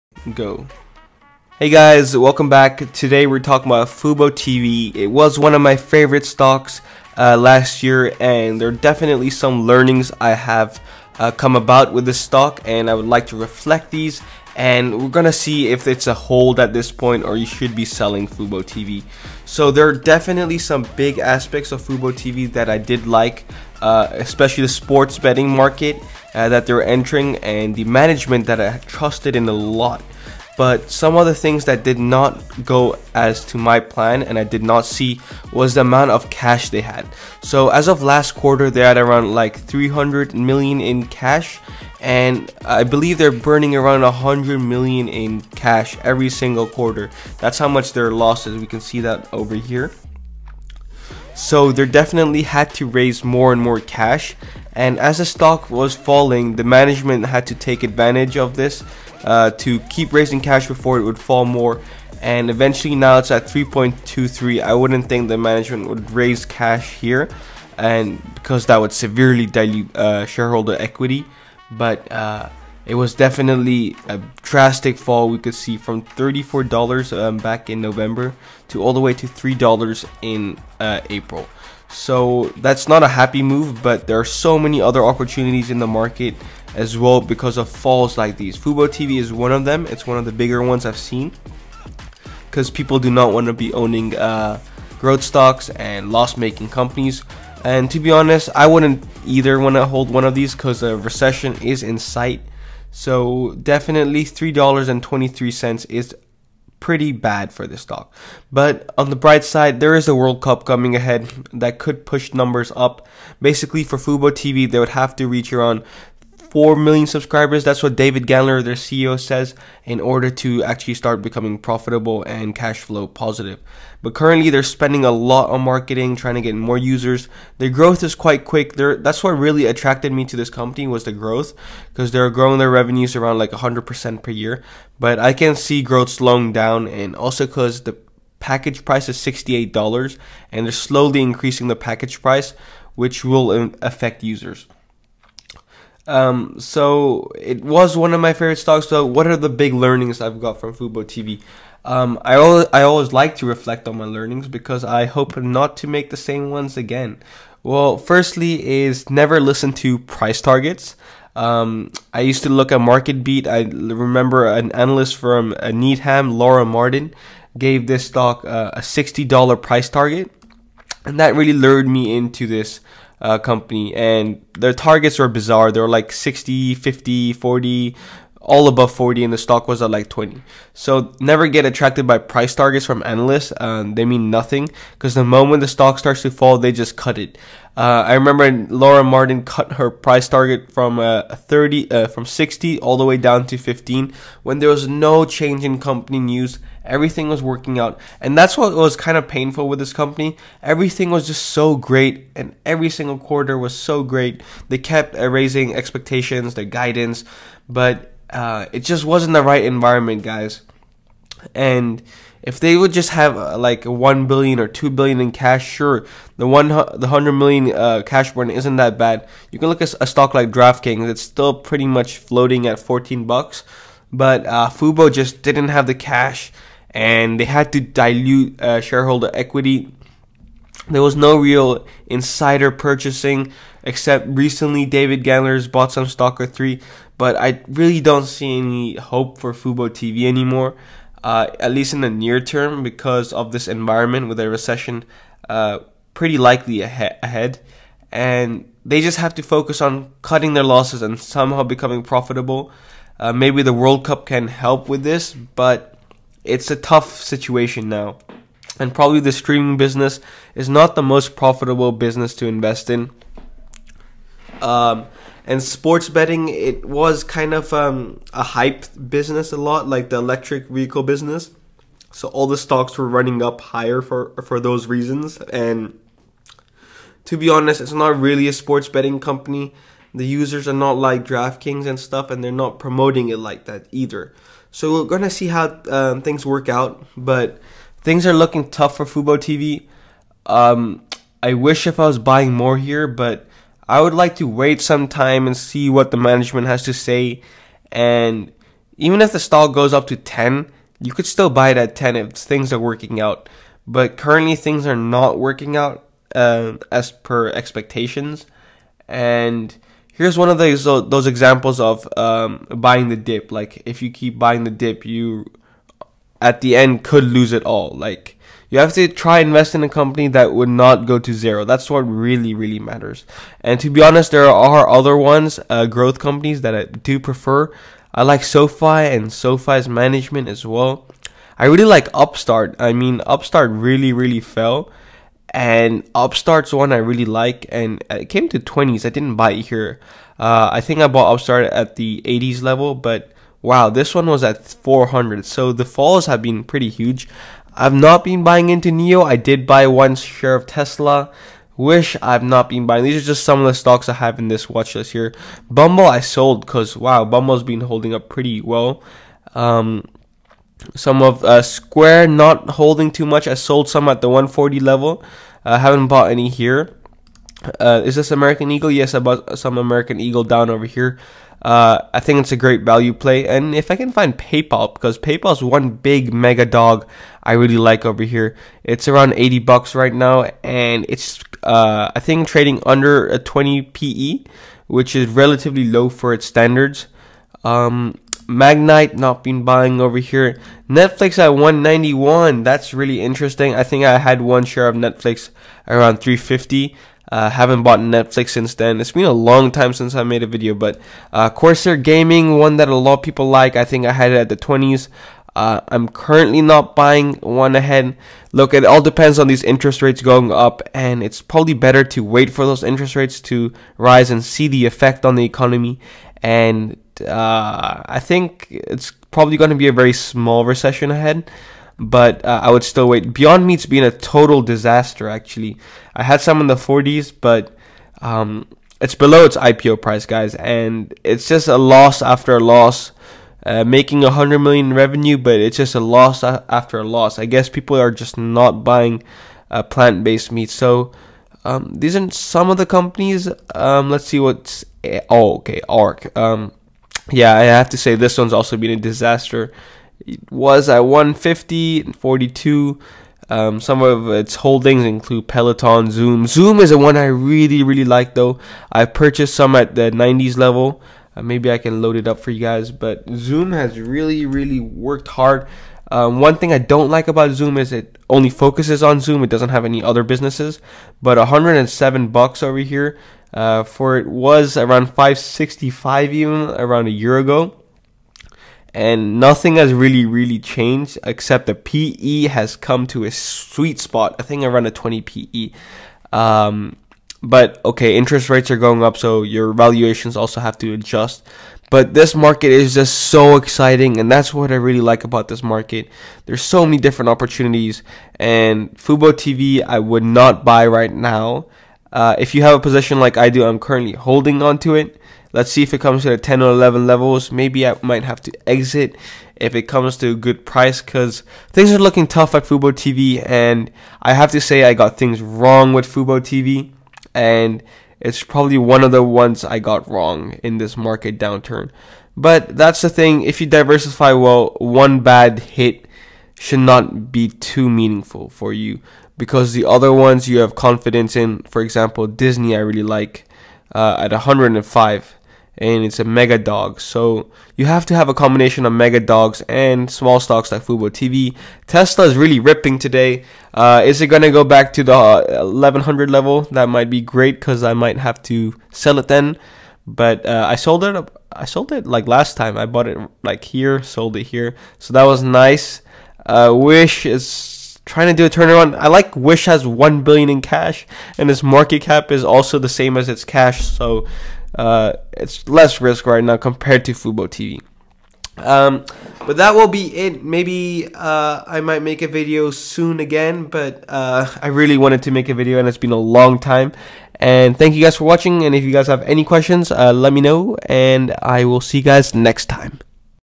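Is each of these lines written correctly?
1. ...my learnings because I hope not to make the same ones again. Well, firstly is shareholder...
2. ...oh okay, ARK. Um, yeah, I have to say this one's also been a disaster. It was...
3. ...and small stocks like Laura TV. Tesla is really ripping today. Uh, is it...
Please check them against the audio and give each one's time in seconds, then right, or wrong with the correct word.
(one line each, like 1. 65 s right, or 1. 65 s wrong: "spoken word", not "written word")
1. 153 s wrong: "never", not "shareholder"
2. 445 s right
3. 539 s wrong: "Fubo", not "Laura".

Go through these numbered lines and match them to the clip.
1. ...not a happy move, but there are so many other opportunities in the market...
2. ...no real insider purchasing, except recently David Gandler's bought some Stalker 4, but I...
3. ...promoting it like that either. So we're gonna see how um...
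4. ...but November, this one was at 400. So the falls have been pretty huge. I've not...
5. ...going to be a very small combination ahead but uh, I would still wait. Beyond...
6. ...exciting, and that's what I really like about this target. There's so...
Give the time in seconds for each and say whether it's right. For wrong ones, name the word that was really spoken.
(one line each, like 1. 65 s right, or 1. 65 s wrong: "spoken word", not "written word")
1. 82 s right
2. 231 s wrong: "3", not "4"
3. 282 s right
4. 342 s wrong: "Wow", not "November"
5. 419 s wrong: "recession", not "combination"
6. 493 s wrong: "market", not "target".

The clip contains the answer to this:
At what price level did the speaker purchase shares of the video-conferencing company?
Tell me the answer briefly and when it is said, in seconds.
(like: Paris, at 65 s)
the 90s, at 460 s.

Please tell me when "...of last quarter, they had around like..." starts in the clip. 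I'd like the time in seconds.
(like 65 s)
37 s.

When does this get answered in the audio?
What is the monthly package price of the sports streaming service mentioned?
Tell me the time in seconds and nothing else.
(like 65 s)
139 s.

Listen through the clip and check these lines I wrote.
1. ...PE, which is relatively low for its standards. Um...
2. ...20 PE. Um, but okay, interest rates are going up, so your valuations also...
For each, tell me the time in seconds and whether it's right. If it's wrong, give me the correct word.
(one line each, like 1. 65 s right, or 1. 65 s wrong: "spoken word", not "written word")
1. 383 s right
2. 484 s right.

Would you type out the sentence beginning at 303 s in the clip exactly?
But currently, things are not working out uh, as per expectations.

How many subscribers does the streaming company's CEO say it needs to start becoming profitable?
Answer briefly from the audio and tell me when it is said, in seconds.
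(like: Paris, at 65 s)
4 million, at 116 s.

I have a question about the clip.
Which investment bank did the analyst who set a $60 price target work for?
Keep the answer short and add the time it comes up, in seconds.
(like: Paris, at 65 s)
Needham, at 165 s.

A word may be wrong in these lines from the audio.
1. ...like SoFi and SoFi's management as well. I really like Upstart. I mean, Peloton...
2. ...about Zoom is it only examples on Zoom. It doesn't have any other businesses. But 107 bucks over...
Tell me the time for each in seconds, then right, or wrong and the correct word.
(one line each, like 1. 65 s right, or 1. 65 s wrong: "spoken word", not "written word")
1. 328 s wrong: "Upstart", not "Peloton"
2. 467 s wrong: "focuses", not "examples".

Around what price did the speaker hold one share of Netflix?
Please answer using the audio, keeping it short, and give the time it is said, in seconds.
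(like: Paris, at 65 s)
350, at 396 s.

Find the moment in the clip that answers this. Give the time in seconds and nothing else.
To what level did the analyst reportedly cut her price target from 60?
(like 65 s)
193 s.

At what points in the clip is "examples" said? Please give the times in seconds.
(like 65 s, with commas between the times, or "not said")
311 s, 531 s.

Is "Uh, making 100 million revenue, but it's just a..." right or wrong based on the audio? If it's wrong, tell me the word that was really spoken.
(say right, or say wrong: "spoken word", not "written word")
right.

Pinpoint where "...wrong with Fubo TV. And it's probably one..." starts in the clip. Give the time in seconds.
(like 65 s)
515 s.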